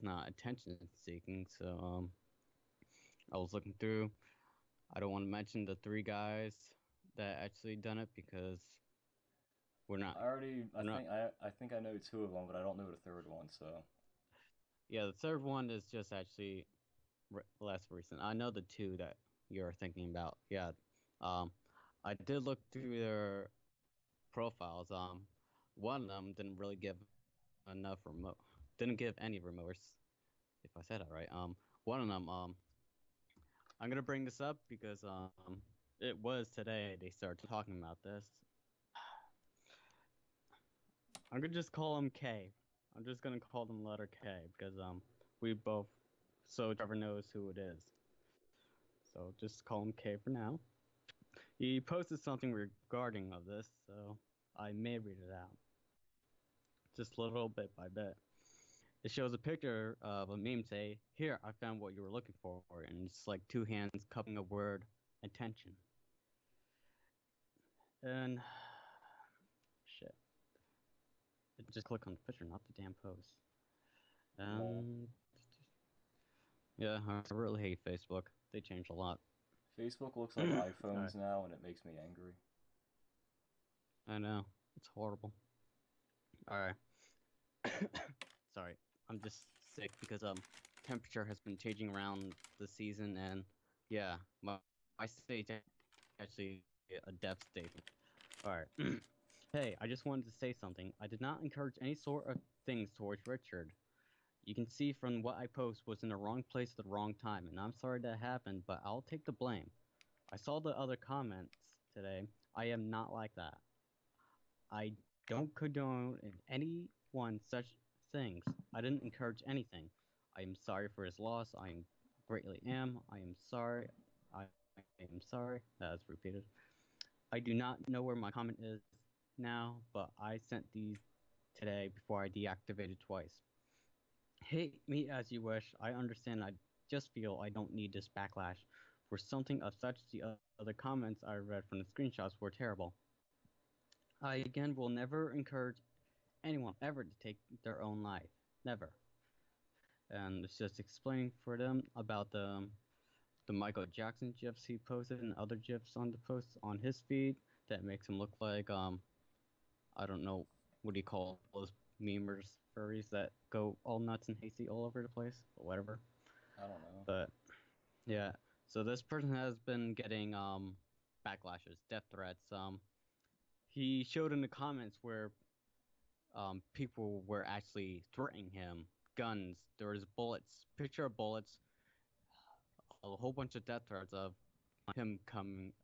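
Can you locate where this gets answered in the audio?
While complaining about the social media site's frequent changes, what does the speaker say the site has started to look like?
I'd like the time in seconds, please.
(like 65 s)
80 s.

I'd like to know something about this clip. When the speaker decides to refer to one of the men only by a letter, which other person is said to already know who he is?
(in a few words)
Trevor.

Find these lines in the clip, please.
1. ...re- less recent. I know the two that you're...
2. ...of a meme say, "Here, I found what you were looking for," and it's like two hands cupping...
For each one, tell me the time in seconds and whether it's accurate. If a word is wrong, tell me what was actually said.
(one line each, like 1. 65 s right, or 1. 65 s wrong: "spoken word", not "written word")
1. 17 s right
2. 60 s right.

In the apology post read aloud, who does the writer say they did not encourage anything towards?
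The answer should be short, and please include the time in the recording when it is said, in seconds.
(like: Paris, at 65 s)
Richard, at 103 s.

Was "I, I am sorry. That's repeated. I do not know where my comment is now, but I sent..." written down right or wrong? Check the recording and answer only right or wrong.
right.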